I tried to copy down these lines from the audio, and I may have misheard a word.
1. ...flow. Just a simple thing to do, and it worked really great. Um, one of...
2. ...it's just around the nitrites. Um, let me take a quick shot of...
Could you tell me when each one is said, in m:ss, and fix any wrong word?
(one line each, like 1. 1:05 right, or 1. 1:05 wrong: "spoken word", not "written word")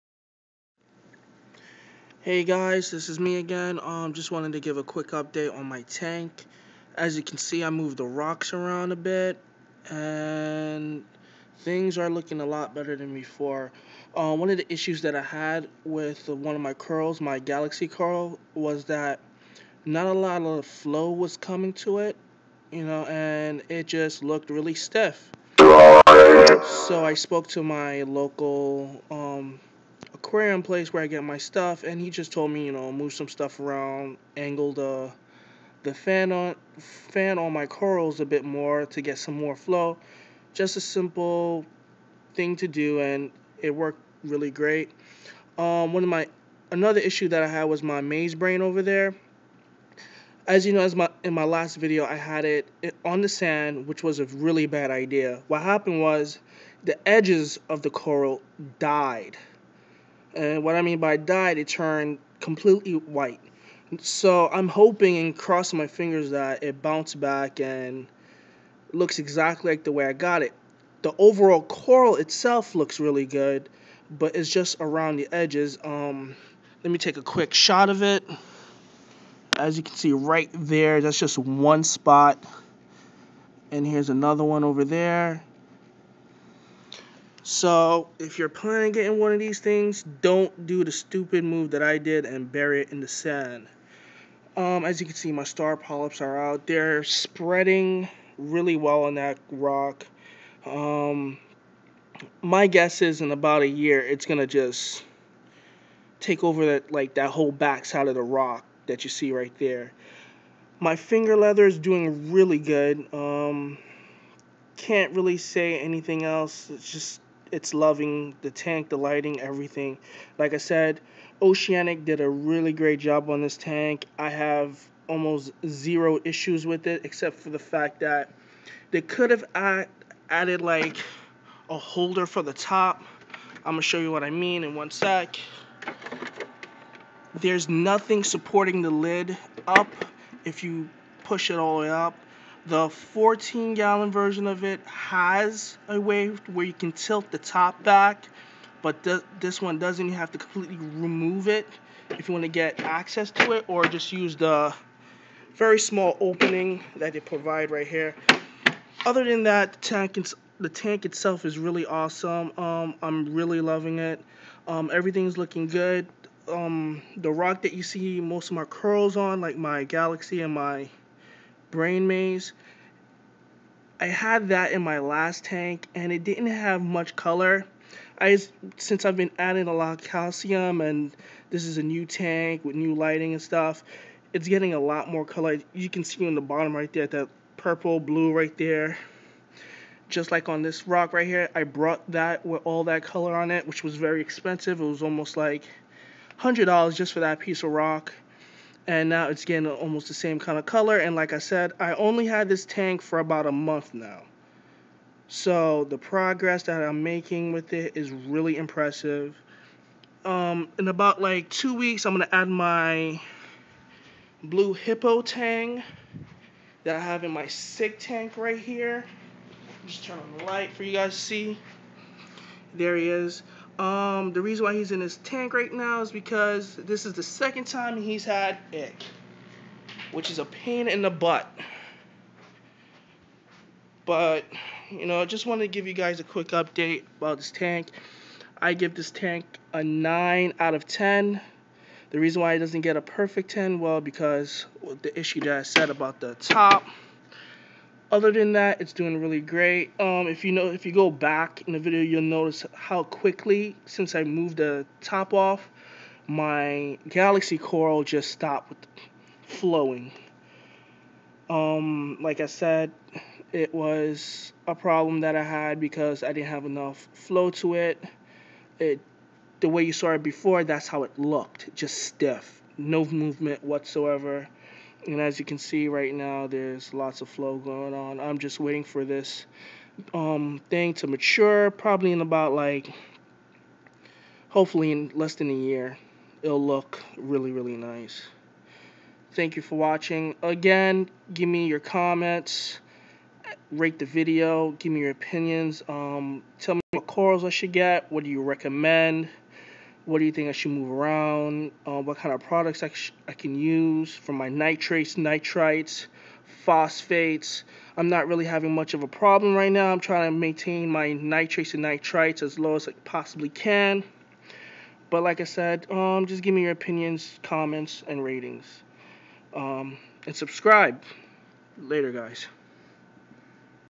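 1. 0:39 right
2. 1:14 wrong: "edges", not "nitrites".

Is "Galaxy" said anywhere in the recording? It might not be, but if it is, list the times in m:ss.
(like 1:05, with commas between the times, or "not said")
0:17, 2:49, 4:17.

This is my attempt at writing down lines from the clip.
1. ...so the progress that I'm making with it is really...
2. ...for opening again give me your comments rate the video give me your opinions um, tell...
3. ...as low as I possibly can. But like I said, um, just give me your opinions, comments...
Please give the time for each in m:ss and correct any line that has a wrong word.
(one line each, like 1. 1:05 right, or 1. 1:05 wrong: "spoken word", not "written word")
1. 3:25 right
2. 4:49 wrong: "watching", not "opening"
3. 5:12 right.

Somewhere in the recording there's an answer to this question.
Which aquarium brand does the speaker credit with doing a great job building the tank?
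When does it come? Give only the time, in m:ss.
2:01.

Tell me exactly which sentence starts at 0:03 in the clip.
Um, just wanted to give a quick update on my tank.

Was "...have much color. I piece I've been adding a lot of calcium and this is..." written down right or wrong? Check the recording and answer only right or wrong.
wrong.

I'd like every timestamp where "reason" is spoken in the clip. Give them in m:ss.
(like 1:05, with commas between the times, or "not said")
3:44, 4:02.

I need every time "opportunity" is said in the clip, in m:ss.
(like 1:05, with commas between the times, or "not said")
not said.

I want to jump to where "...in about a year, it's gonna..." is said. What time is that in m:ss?
1:43.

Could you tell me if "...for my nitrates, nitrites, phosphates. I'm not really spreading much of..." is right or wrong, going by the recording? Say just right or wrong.
wrong.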